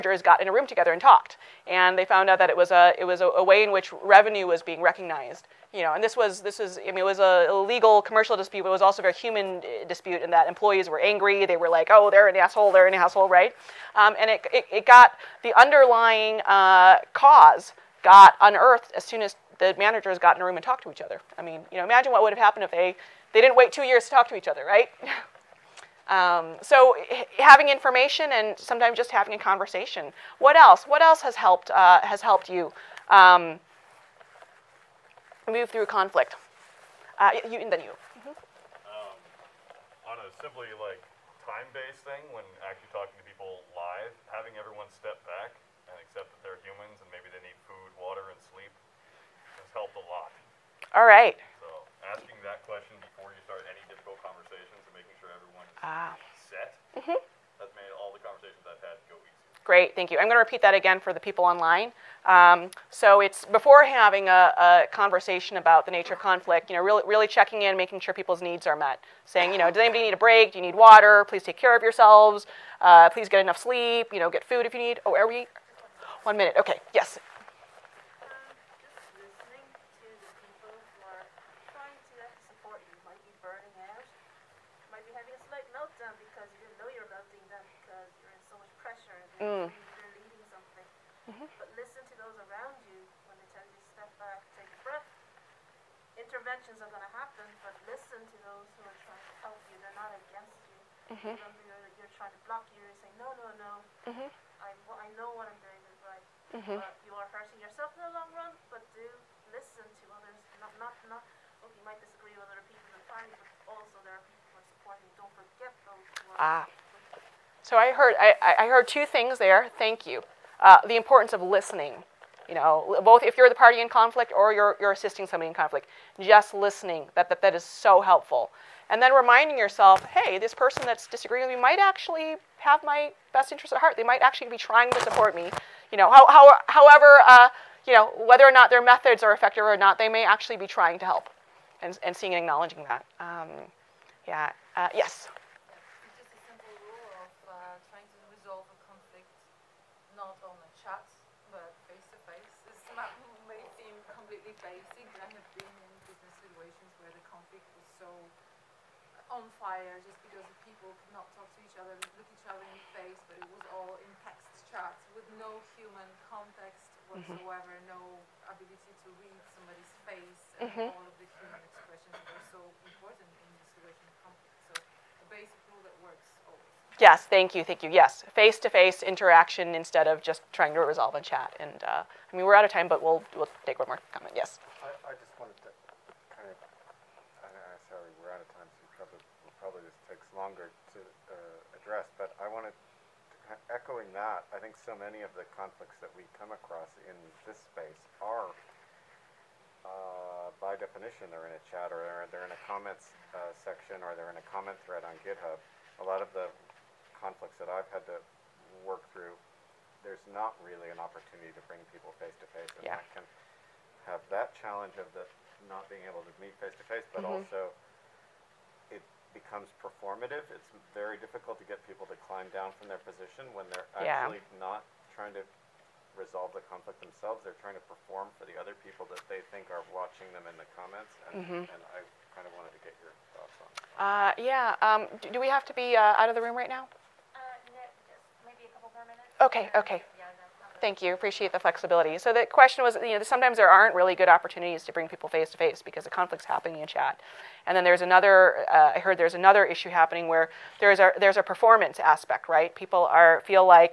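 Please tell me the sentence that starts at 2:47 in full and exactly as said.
no ability to read somebody's face, and mm -hmm.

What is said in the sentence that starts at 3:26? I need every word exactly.
A lot of the conflicts that I've had to work through, there's not really an opportunity to bring people face to face.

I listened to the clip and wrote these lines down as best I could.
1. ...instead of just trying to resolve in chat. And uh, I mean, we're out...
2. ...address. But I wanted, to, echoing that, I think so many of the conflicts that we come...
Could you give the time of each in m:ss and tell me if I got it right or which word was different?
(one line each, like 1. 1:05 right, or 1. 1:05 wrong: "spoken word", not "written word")
1. 2:59 right
2. 3:11 right.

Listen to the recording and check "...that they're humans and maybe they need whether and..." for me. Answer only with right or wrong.
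wrong.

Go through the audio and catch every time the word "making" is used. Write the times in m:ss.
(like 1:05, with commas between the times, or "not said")
0:54, 1:07.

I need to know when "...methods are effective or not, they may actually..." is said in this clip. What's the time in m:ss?
2:18.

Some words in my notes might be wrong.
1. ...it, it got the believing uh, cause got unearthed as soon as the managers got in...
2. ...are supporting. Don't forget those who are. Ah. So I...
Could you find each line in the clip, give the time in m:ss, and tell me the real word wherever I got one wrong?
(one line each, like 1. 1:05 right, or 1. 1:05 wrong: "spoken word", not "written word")
1. 0:14 wrong: "underlying", not "believing"
2. 1:54 right.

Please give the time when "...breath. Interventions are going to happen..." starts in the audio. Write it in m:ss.
1:34.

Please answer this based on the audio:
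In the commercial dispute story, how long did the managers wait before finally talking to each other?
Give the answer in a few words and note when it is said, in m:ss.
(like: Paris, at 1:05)
2 years, at 0:23.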